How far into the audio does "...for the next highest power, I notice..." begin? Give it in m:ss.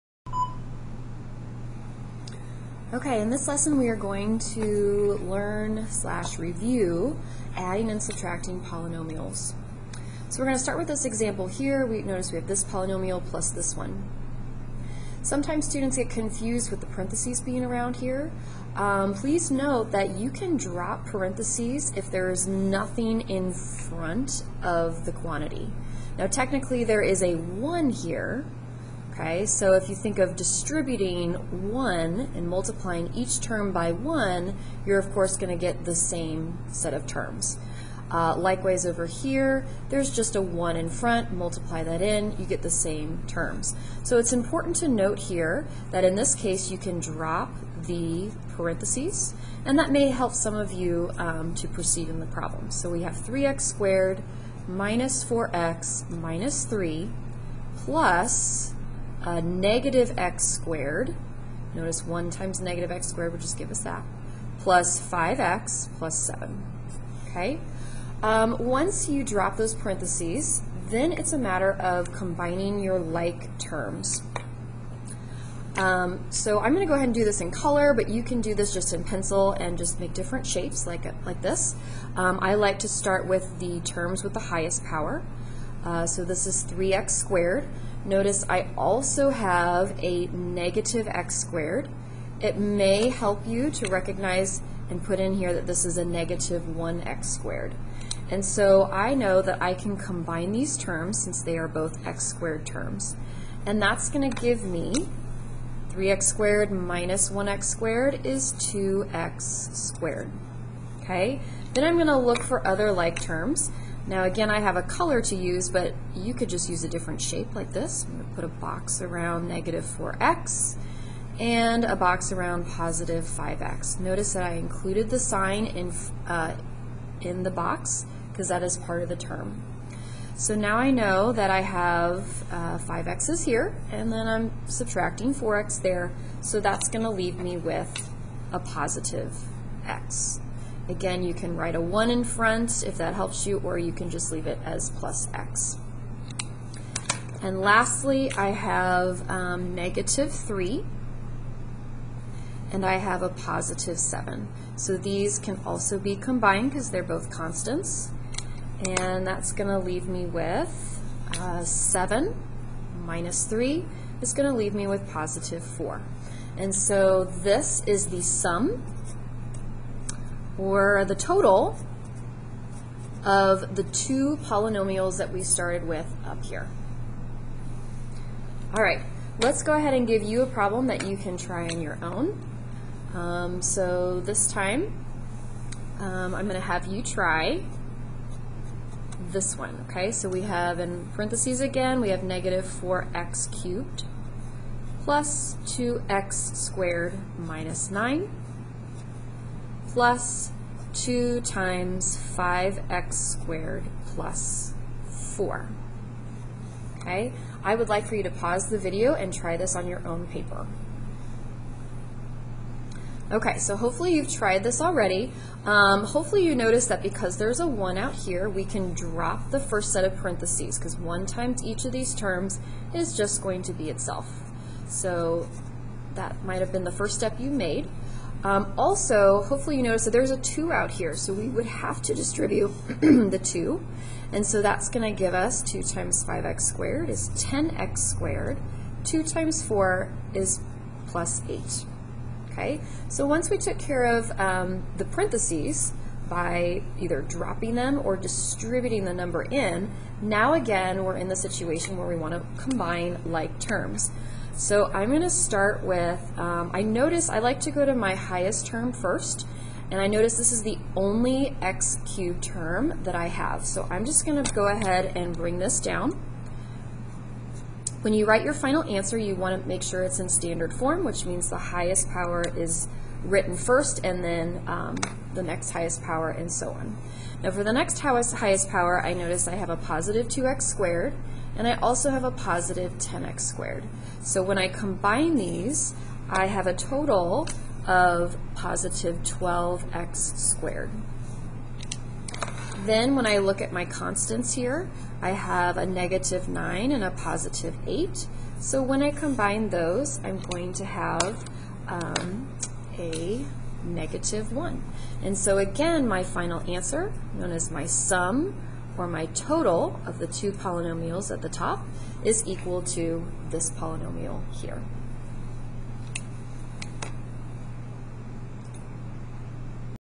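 4:37.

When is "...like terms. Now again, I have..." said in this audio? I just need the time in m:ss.
1:52.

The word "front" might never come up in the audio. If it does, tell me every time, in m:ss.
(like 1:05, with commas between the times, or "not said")
0:23, 0:40, 2:22.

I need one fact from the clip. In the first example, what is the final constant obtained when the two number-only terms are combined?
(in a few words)
positive 4.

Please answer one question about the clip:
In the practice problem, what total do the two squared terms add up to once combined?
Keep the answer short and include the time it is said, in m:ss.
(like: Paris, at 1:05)
12x squared, at 4:49.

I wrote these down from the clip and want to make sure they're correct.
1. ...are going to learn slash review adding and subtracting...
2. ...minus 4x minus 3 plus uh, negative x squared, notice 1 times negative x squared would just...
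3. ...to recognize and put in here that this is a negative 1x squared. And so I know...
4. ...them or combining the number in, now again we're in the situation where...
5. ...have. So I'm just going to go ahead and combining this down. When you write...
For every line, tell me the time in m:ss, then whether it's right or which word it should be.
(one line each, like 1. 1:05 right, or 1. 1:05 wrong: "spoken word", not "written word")
1. 0:03 right
2. 0:54 right
3. 1:33 right
4. 4:07 wrong: "distributing", not "combining"
5. 4:23 wrong: "bring", not "combining".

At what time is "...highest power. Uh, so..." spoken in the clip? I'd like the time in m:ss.
1:24.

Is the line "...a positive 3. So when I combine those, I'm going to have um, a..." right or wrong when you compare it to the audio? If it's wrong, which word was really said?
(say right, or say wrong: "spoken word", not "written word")
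wrong: "8", not "3".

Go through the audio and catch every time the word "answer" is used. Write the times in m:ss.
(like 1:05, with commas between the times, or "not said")
4:28, 5:06.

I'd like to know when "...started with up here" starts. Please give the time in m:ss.
2:55.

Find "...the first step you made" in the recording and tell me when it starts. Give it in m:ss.
3:46.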